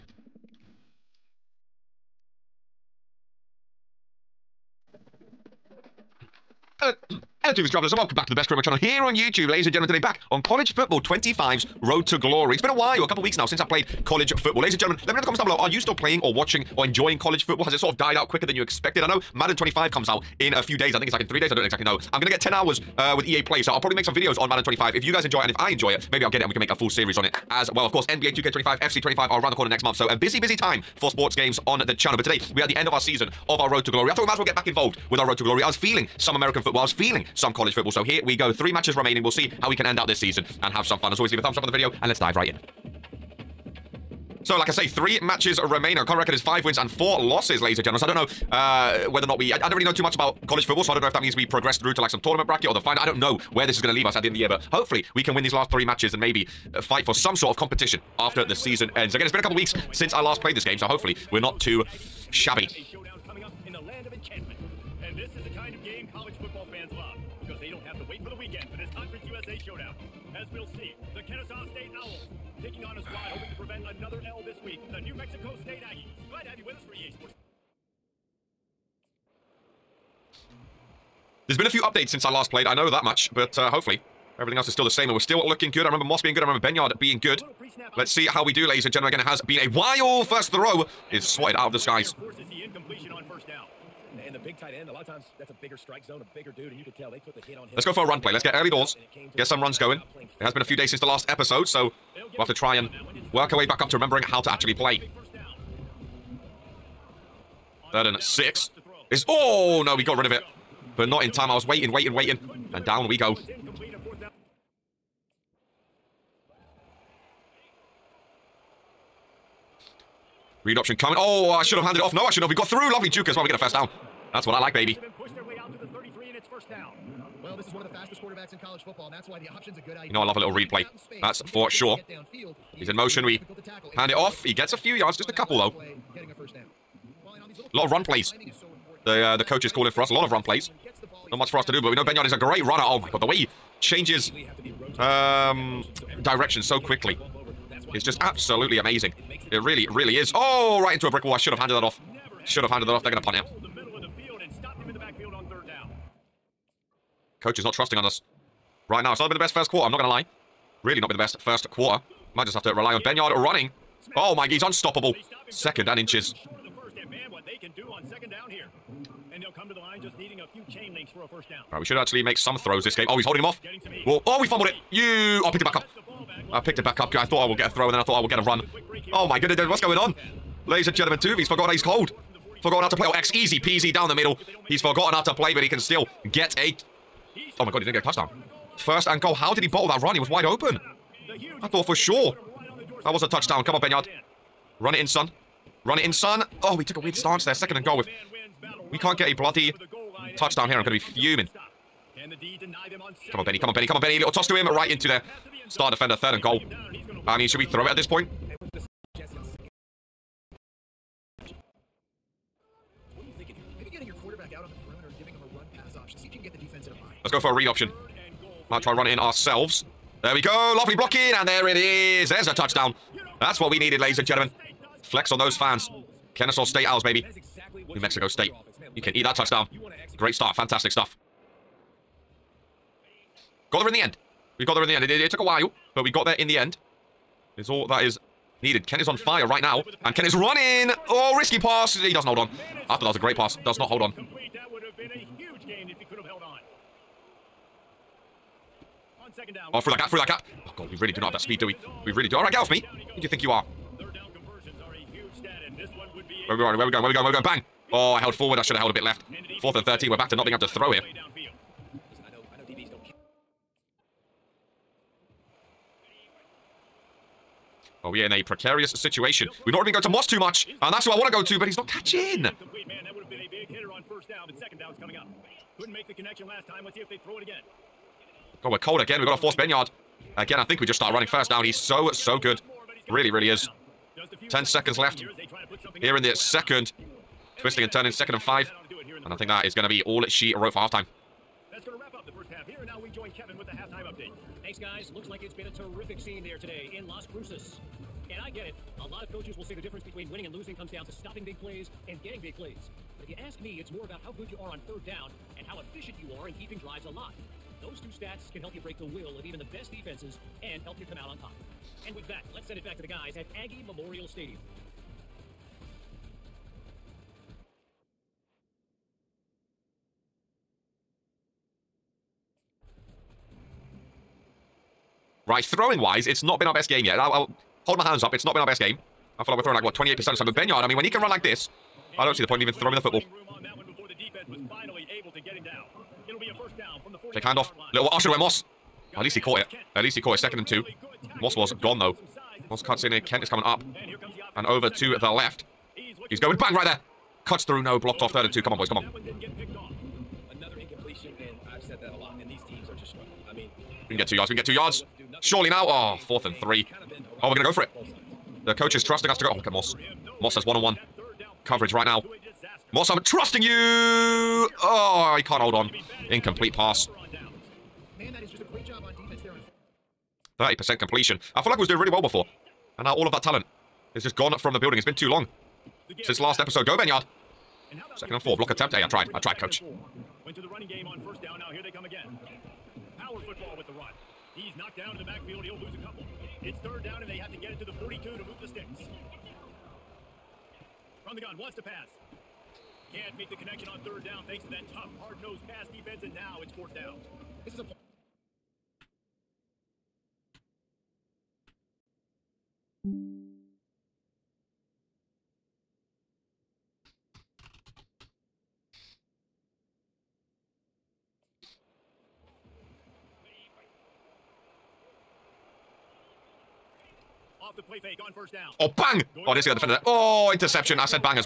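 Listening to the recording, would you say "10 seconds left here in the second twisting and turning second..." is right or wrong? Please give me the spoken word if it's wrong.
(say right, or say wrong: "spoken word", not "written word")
right.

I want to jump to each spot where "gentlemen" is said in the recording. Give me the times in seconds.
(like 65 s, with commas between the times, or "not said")
9 s, 14 s, 47 s, 88 s, 180 s, 224 s.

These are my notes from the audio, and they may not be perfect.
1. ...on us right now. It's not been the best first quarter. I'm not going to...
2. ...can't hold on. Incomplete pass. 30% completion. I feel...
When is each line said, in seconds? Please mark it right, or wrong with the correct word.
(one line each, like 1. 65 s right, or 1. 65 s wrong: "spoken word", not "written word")
1. 157 s right
2. 365 s right.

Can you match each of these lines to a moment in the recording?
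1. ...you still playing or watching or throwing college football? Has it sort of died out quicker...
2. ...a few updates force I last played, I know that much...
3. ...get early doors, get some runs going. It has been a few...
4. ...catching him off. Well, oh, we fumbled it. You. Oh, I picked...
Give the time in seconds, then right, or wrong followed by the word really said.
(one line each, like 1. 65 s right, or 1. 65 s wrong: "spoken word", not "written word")
1. 15 s wrong: "enjoying", not "throwing"
2. 81 s wrong: "since", not "force"
3. 98 s right
4. 173 s wrong: "holding", not "catching".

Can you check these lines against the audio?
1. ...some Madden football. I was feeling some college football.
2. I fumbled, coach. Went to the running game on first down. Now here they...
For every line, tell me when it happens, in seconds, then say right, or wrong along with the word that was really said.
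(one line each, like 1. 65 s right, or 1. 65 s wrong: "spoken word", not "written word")
1. 36 s wrong: "American", not "Madden"
2. 379 s wrong: "tried", not "fumbled".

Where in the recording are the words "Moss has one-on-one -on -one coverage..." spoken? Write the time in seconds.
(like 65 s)
360 s.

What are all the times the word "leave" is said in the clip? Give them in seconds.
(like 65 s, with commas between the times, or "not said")
41 s, 53 s.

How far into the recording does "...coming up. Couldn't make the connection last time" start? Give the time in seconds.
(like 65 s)
275 s.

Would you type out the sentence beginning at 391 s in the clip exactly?
From the gun, wants to pass.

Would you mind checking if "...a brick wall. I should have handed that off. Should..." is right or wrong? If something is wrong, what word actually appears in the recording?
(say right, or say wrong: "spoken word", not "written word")
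right.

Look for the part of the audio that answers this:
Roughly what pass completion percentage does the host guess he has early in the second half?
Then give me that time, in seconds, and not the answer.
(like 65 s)
329 s.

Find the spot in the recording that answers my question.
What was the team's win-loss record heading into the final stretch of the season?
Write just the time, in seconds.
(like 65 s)
46 s.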